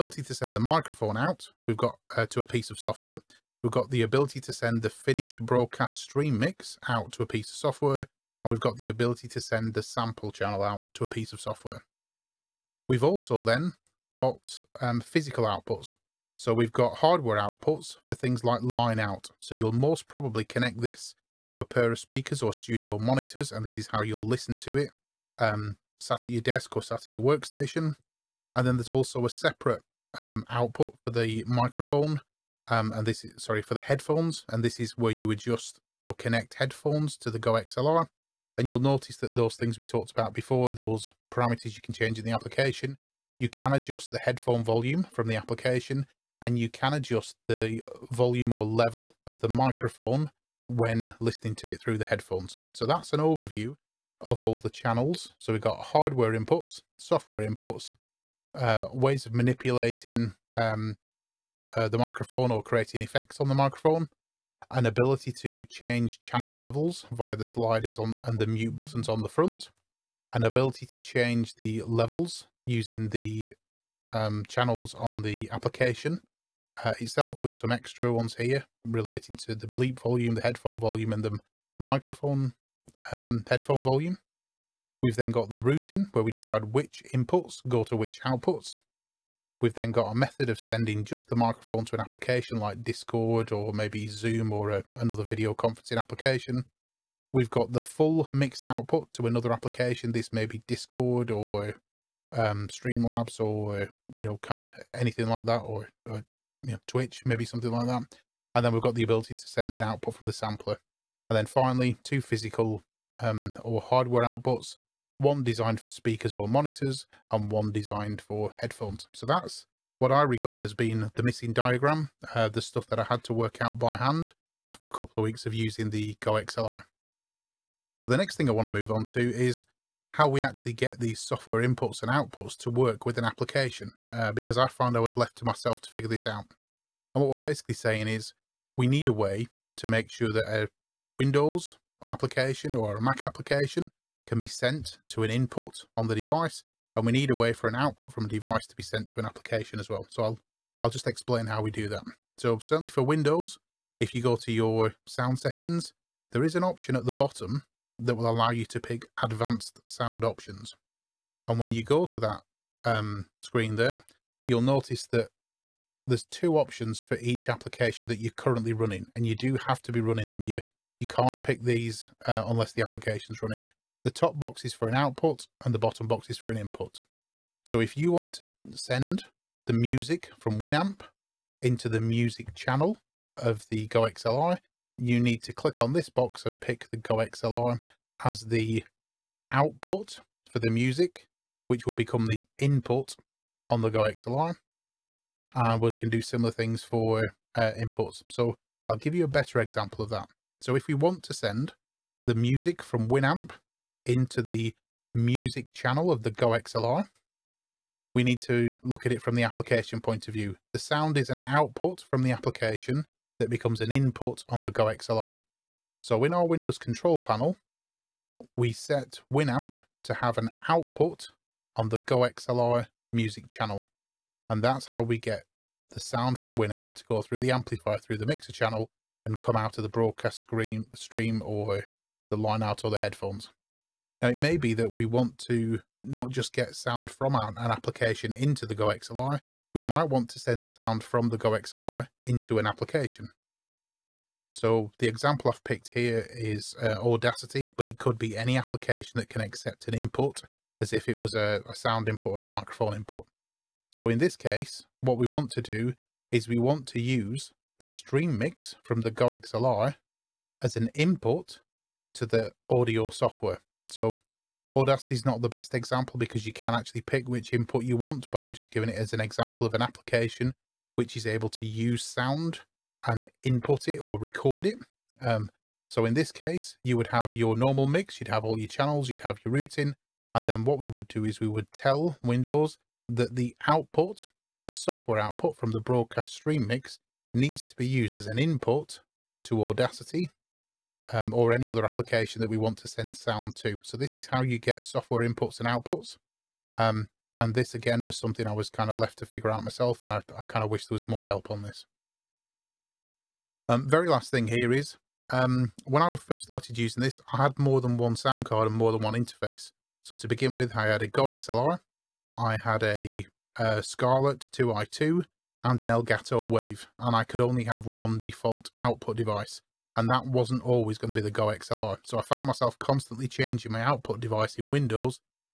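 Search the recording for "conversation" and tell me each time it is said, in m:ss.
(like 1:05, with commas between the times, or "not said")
not said.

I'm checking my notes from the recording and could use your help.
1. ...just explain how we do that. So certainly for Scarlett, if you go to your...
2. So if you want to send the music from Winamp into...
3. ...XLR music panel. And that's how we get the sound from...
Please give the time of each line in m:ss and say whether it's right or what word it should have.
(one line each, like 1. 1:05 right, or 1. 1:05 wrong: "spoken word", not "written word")
1. 2:30 wrong: "Windows", not "Scarlett"
2. 2:57 right
3. 3:42 wrong: "channel", not "panel".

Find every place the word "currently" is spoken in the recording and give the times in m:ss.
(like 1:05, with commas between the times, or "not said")
2:48.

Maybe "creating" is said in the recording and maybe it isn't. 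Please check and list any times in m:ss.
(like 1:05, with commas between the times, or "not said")
1:02.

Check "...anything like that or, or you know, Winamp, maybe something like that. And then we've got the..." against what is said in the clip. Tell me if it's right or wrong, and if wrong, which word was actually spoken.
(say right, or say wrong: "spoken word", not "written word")
wrong: "Twitch", not "Winamp".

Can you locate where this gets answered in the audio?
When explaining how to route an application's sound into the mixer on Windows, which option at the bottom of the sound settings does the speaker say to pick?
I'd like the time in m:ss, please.
2:39.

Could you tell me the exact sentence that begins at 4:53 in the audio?
So this is how you get software inputs and outputs.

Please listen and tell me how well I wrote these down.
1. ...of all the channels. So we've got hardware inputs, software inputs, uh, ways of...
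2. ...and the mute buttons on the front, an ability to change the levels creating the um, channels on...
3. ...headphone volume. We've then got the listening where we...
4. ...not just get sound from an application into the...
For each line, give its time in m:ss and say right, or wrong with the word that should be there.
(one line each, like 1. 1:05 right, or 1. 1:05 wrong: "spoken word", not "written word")
1. 0:54 right
2. 1:08 wrong: "using", not "creating"
3. 1:23 wrong: "routing", not "listening"
4. 3:56 right.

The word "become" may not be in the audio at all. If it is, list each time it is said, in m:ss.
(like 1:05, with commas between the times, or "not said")
3:11, 3:33.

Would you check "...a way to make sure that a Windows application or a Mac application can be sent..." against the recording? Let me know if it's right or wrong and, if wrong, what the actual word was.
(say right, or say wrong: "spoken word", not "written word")
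right.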